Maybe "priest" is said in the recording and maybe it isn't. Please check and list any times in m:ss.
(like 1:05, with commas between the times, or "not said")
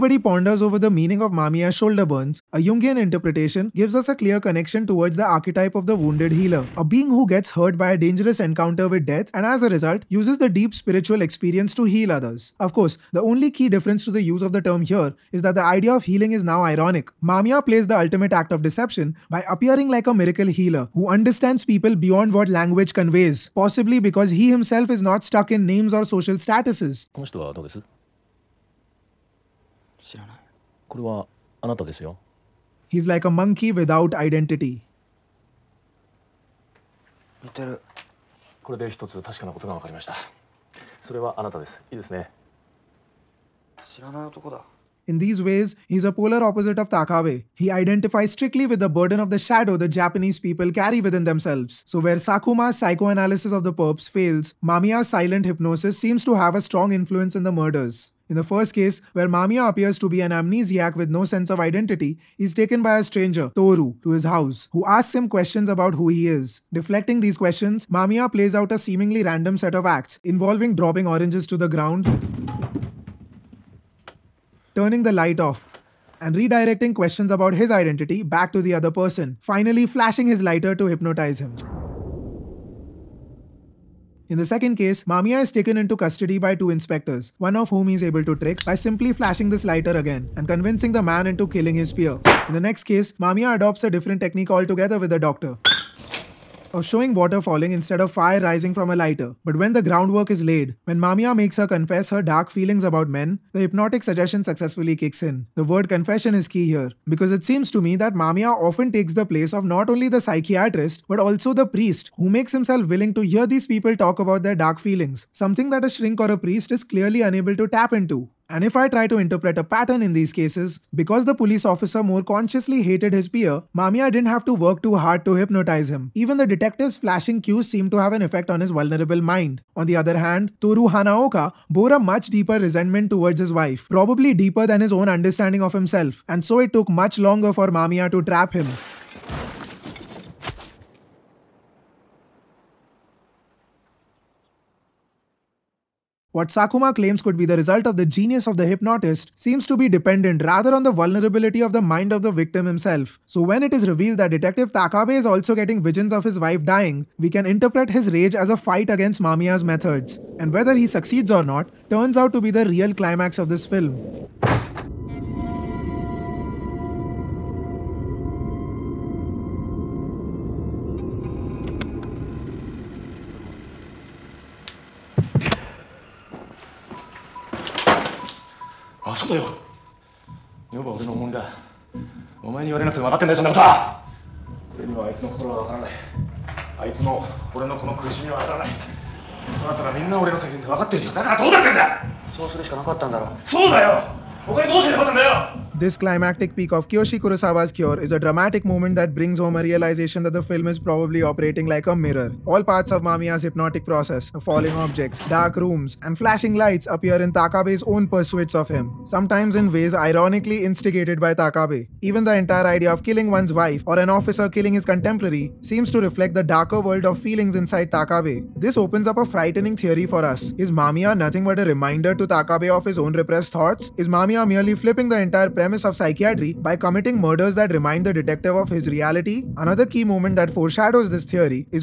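1:51, 1:56.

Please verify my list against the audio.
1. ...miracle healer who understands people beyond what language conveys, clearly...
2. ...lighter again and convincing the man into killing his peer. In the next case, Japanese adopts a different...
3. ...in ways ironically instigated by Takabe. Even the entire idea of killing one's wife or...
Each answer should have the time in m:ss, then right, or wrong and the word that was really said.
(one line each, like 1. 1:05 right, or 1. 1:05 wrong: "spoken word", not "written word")
1. 0:20 wrong: "possibly", not "clearly"
2. 1:29 wrong: "Mamiya", not "Japanese"
3. 3:29 right.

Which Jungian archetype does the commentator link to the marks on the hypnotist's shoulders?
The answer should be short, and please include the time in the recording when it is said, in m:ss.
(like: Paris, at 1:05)
wounded healer, at 0:05.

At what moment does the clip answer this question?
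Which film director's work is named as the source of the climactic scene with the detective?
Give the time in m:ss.
3:16.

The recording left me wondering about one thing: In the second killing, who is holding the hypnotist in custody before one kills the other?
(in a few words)
two inspectors.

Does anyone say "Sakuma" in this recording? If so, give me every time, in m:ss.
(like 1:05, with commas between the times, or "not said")
0:52, 2:26.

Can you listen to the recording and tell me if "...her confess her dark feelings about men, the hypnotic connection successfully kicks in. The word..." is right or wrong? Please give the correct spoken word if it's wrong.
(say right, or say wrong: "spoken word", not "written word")
wrong: "suggestion", not "connection".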